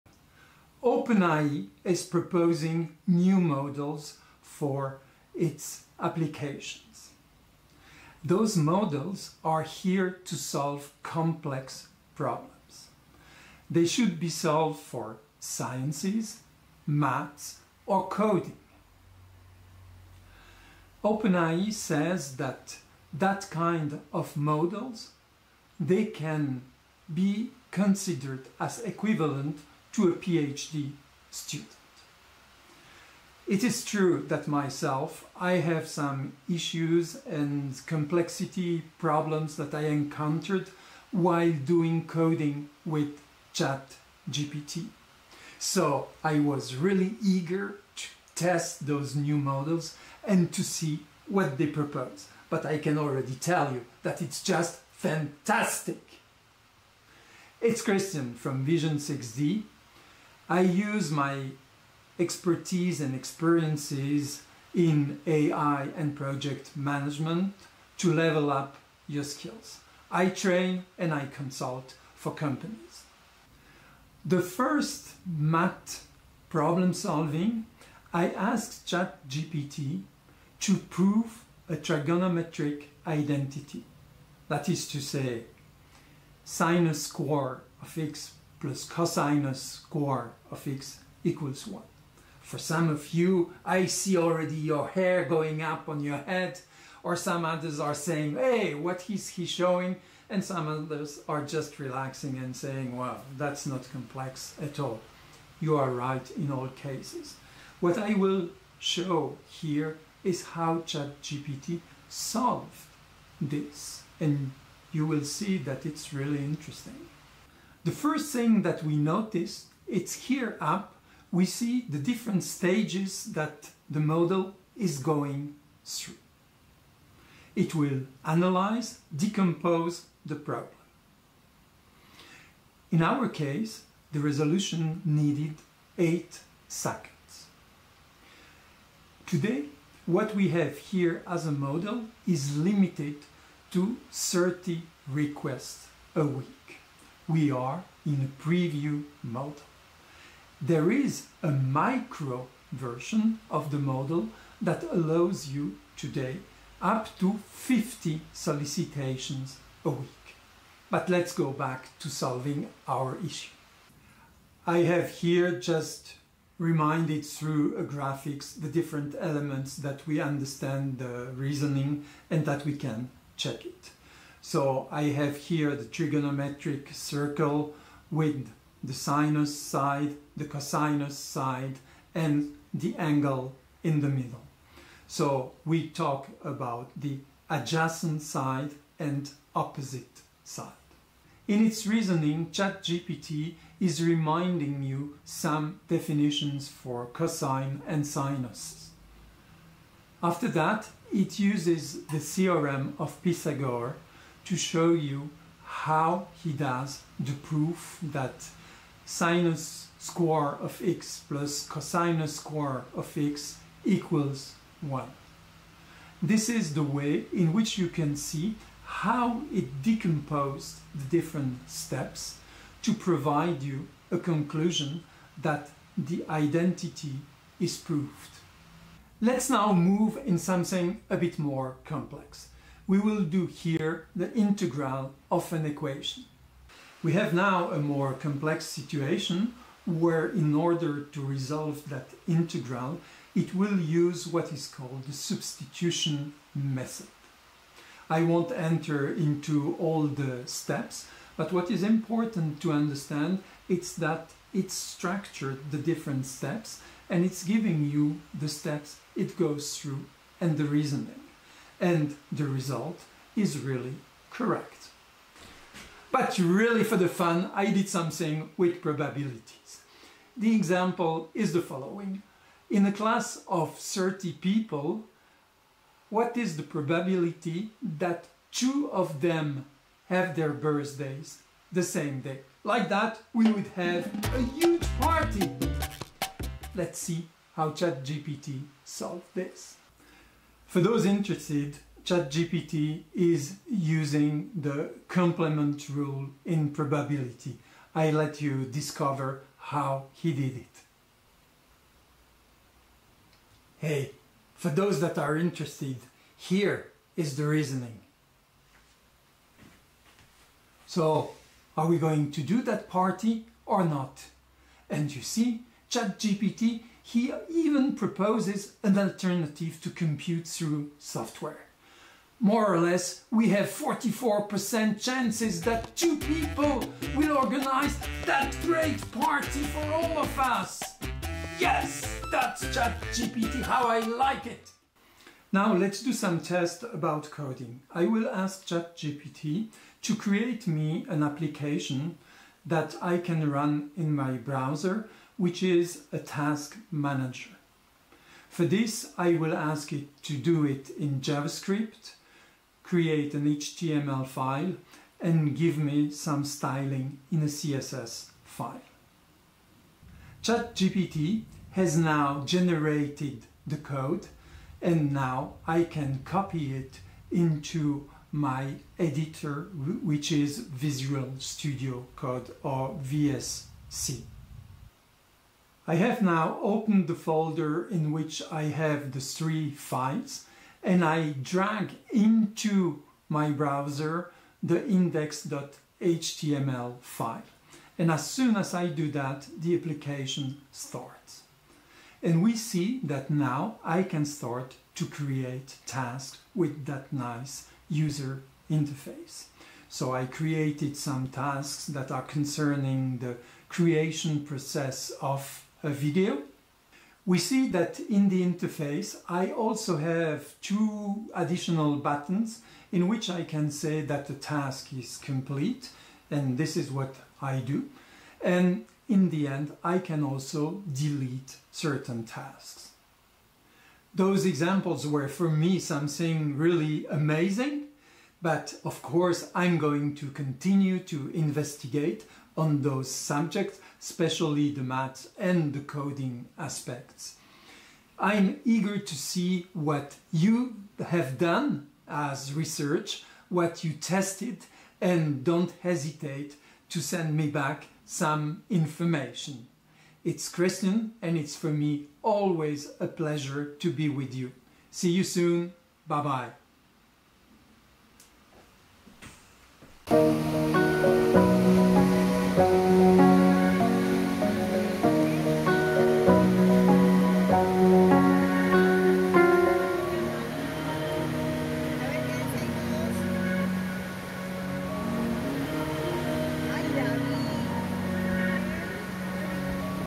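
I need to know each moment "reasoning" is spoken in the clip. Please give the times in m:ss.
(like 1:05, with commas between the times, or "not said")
2:51, 3:11, 4:20, 5:07.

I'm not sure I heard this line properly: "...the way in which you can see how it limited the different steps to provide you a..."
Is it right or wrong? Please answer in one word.
wrong.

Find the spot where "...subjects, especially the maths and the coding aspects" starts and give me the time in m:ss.
7:13.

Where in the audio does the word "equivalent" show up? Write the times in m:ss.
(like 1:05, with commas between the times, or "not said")
0:28.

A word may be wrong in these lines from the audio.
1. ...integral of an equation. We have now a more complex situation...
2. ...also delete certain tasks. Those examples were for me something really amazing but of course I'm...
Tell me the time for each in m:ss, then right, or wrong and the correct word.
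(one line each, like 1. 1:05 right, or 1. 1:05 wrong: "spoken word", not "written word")
1. 3:54 right
2. 7:00 right.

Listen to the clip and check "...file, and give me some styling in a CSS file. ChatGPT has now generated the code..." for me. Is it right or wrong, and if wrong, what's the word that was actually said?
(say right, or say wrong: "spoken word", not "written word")
right.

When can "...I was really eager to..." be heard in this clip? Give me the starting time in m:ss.
0:46.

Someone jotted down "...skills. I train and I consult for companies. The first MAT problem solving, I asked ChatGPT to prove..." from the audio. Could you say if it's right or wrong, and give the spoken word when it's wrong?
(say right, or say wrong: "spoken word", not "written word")
right.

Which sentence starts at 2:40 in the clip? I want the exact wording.
But let's go back to solving our issue.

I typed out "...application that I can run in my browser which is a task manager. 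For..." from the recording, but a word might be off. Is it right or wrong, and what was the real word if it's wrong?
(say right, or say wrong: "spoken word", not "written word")
right.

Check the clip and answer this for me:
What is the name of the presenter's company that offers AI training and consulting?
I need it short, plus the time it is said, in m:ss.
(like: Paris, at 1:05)
Vision 6D, at 0:58.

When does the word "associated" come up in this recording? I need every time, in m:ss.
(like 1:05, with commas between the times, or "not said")
not said.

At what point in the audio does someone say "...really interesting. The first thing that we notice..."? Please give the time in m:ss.
1:56.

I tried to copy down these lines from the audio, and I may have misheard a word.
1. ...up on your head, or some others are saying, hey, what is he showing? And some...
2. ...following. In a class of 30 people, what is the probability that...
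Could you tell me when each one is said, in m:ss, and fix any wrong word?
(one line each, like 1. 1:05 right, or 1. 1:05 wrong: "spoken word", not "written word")
1. 1:35 right
2. 4:31 right.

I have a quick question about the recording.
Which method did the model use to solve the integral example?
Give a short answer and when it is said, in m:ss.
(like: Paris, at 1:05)
Substitution method, at 4:05.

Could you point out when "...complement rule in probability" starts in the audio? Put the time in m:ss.
4:55.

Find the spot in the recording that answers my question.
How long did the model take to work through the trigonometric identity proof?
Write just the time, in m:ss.
2:15.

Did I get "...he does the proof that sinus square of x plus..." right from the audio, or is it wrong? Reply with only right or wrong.
right.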